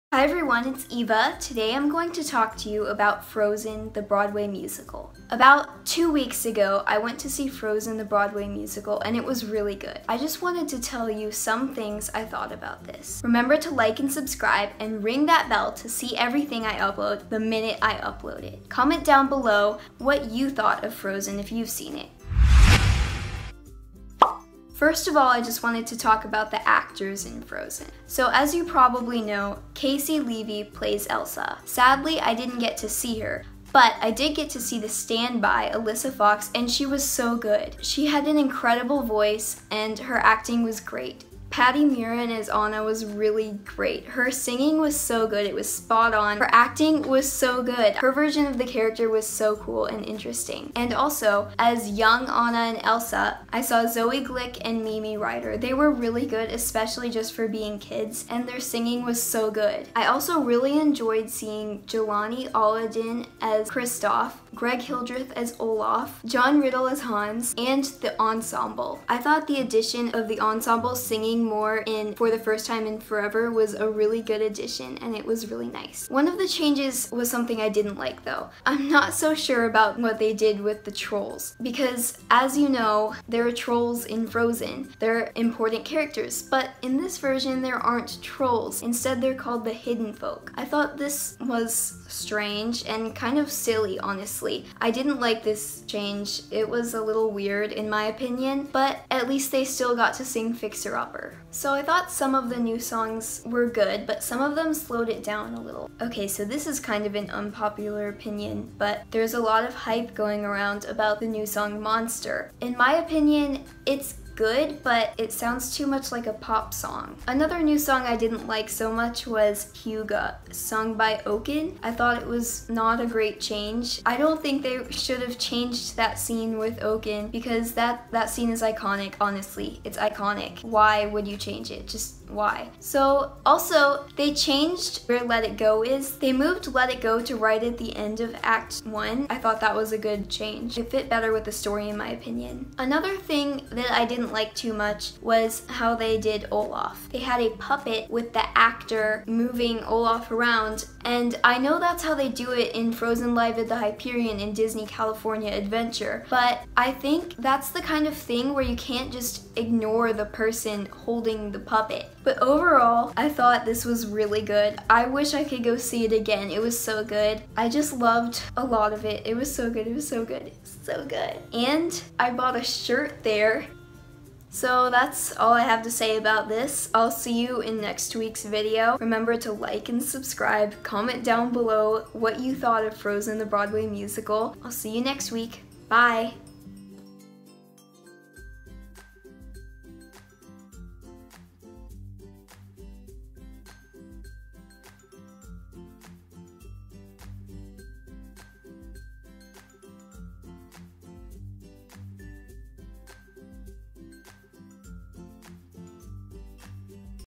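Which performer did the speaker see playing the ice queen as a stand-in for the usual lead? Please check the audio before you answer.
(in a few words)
Alyssa Fox.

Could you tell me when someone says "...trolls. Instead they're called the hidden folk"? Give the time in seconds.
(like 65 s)
88 s.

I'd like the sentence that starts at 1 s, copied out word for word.
Today I'm going to talk to you about Frozen, the Broadway musical.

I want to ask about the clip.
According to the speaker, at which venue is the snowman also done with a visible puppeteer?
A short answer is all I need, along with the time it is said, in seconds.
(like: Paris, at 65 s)
the Hyperion, at 153 s.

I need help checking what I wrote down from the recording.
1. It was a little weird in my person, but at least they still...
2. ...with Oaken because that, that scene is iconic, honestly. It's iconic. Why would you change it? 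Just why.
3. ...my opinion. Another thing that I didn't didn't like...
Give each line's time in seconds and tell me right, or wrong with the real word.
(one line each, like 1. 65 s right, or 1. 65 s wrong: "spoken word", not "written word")
1. 96 s wrong: "opinion", not "person"
2. 126 s right
3. 141 s right.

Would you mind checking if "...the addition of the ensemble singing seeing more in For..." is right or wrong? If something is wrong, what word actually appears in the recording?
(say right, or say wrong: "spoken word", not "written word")
right.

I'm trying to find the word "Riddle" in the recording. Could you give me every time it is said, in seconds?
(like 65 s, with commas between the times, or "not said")
66 s.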